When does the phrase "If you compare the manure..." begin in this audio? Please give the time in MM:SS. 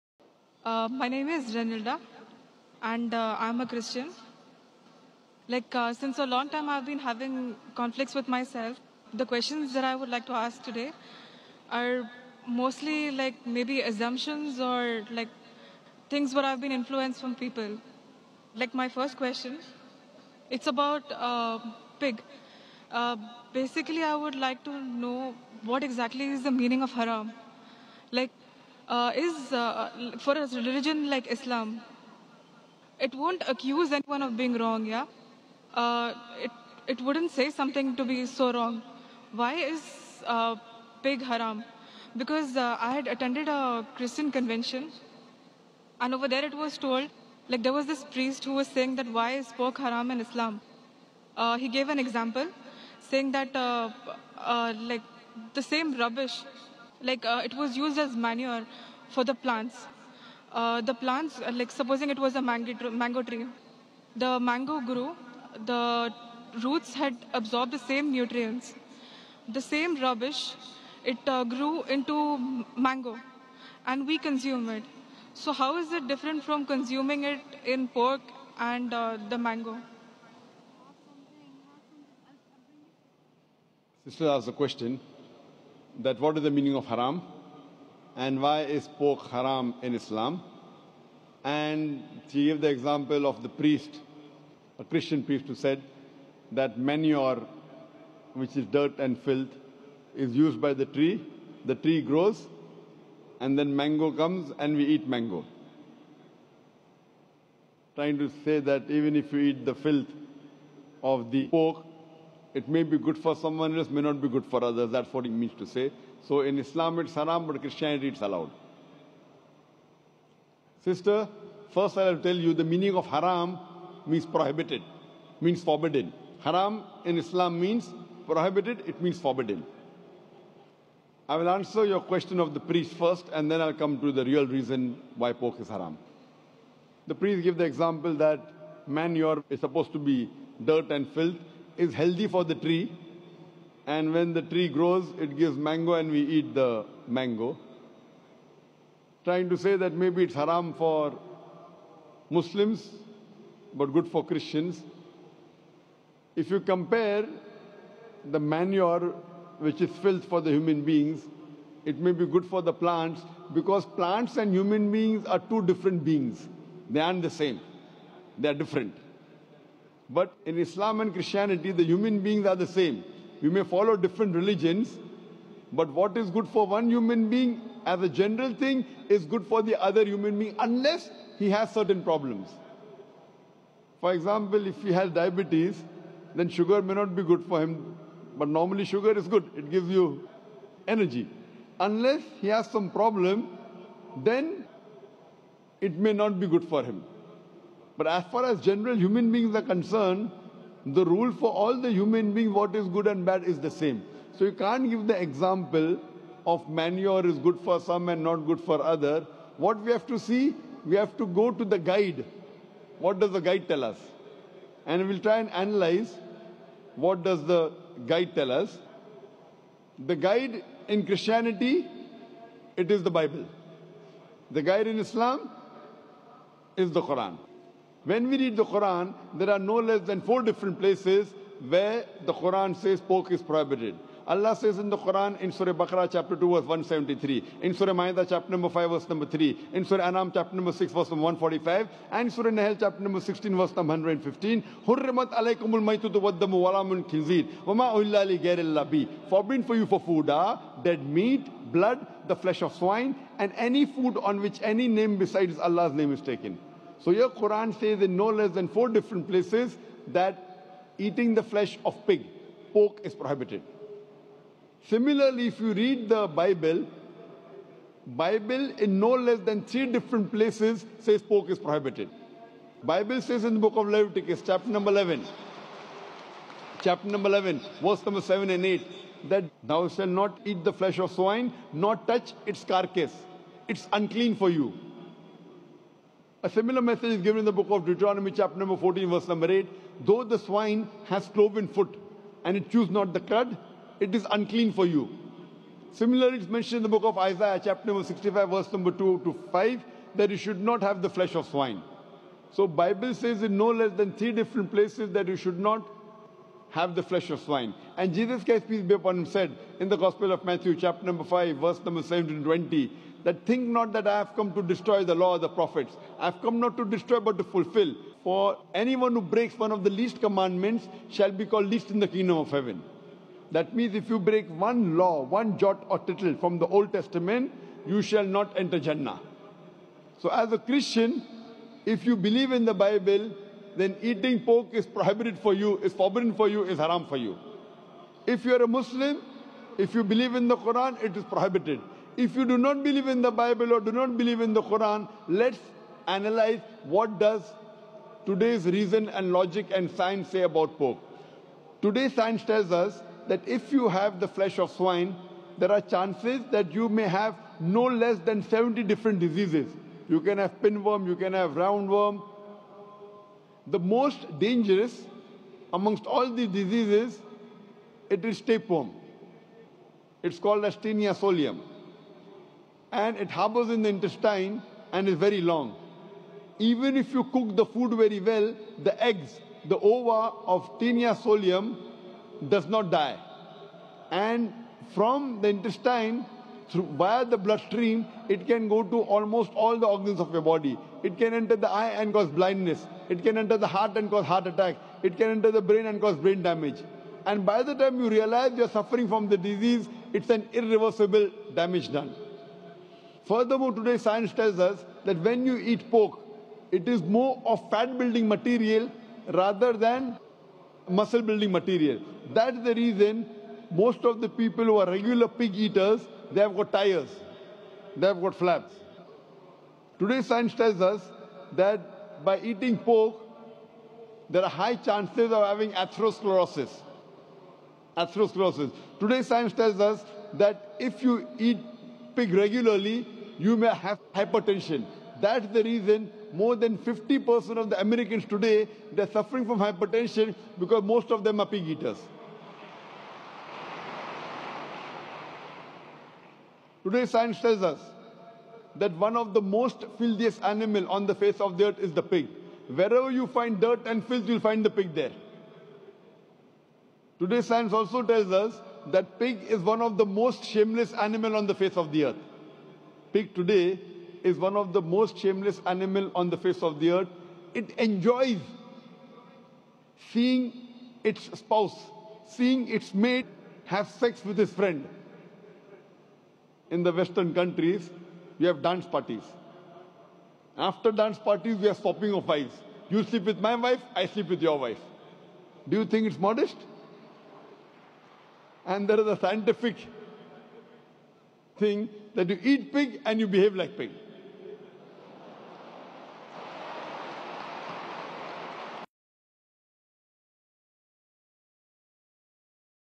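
02:36.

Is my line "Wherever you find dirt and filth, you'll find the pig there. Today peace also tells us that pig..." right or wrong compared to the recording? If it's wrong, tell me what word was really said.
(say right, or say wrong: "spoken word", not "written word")
wrong: "science", not "peace".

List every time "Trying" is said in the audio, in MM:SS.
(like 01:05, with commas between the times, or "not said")
01:47, 02:29.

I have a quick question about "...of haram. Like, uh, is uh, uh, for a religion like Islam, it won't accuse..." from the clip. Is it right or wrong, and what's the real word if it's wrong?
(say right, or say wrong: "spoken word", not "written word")
right.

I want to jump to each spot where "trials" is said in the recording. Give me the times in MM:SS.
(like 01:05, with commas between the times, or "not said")
not said.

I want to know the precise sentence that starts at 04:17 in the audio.
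So your Quran says in no less than four different places that eating the flesh of pig, pork is prohibited.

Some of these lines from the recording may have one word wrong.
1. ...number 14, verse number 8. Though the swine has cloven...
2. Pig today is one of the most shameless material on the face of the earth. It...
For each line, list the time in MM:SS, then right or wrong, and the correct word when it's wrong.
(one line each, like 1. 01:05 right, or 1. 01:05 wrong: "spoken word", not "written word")
1. 04:48 right
2. 07:43 wrong: "animal", not "material".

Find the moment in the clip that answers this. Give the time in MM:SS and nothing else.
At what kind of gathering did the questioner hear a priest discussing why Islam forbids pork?
00:43.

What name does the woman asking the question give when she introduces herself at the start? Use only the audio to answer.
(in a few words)
Renilda.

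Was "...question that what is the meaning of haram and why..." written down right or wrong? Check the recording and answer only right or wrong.
right.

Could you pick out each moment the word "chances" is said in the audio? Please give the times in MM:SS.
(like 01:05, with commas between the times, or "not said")
05:55, 07:04.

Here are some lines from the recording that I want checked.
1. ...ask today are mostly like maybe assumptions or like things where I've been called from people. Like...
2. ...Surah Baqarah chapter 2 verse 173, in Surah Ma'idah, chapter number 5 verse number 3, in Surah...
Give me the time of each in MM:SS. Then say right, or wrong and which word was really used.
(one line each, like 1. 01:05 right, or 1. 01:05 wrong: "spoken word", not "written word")
1. 00:10 wrong: "influenced", not "called"
2. 03:55 right.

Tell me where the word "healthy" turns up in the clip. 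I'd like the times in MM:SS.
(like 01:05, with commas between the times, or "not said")
02:21.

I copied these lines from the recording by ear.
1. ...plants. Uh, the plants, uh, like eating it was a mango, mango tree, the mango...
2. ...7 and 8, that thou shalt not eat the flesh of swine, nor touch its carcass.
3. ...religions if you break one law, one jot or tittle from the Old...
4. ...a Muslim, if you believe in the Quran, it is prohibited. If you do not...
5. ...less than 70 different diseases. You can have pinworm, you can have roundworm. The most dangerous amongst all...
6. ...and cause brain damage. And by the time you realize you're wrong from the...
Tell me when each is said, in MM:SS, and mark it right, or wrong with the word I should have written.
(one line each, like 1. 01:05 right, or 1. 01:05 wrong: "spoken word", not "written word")
1. 00:59 wrong: "supposing", not "eating"
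2. 04:38 right
3. 05:23 wrong: "means", not "religions"
4. 05:38 right
5. 05:57 right
6. 06:35 wrong: "suffering", not "wrong".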